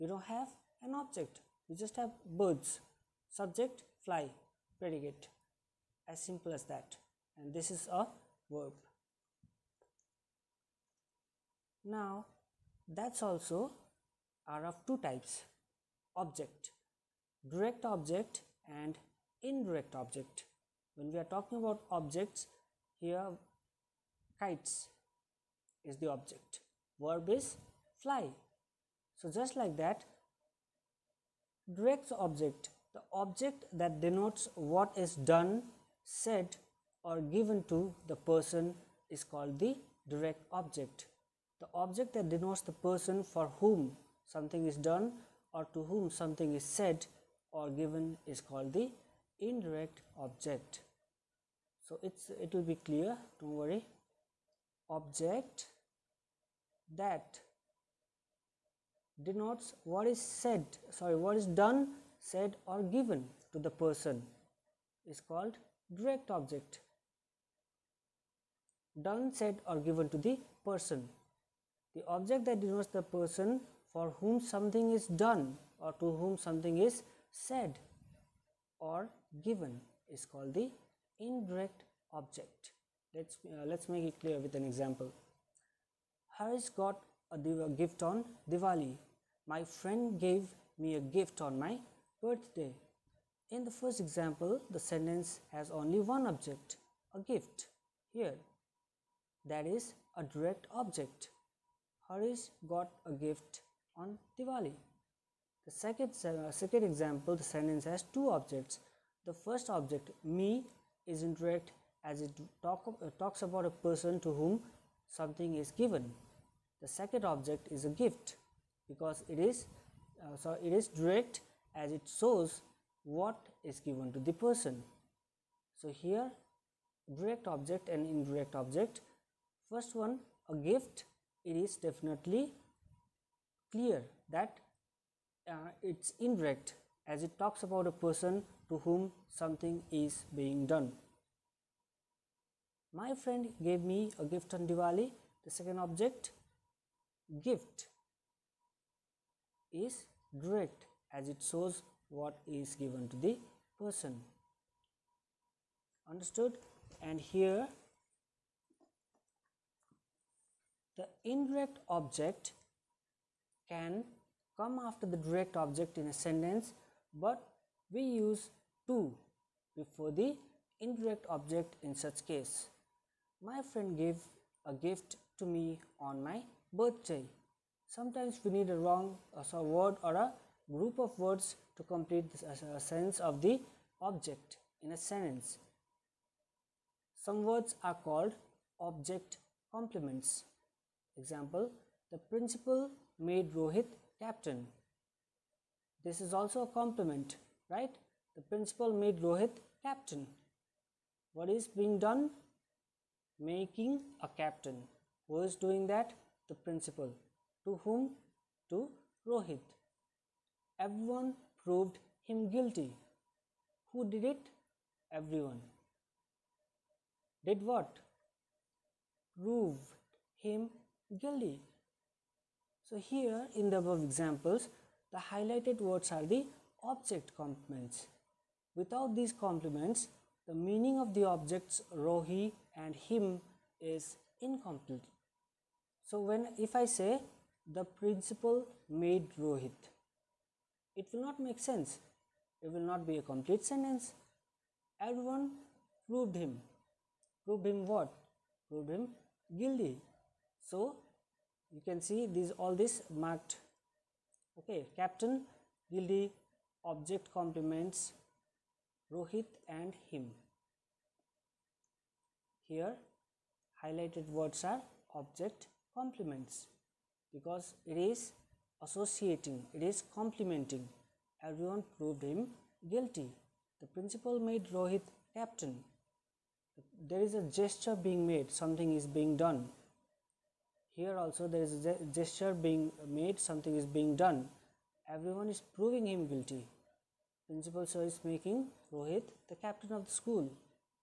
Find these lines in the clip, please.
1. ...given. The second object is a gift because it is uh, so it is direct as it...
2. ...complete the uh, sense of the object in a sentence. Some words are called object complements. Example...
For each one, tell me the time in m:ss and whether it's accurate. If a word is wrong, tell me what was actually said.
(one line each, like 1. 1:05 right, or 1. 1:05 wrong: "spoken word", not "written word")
1. 1:55 right
2. 3:01 right.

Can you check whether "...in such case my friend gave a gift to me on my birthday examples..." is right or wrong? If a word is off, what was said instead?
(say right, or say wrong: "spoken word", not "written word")
wrong: "sometimes", not "examples".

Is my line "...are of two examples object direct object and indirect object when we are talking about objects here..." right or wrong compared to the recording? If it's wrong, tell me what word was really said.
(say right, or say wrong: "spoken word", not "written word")
wrong: "types", not "examples".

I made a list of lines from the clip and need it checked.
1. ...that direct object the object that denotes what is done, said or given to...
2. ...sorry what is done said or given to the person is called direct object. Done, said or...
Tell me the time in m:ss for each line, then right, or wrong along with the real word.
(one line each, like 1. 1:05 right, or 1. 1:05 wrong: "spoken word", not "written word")
1. 0:29 right
2. 1:00 right.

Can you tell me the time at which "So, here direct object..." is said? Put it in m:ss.
2:05.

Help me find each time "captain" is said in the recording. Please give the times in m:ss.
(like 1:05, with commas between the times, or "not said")
3:14, 3:19, 3:24, 4:14, 4:35, 4:49.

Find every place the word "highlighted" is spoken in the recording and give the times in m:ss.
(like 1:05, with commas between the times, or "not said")
3:45, 4:23.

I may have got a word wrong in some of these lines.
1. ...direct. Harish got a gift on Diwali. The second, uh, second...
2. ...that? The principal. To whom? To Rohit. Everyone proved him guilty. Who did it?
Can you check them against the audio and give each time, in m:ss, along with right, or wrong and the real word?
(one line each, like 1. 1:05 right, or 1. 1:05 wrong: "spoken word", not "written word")
1. 1:40 wrong: "object", not "direct"
2. 3:25 right.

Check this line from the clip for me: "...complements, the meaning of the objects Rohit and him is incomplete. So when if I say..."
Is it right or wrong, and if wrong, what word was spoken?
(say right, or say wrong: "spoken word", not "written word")
right.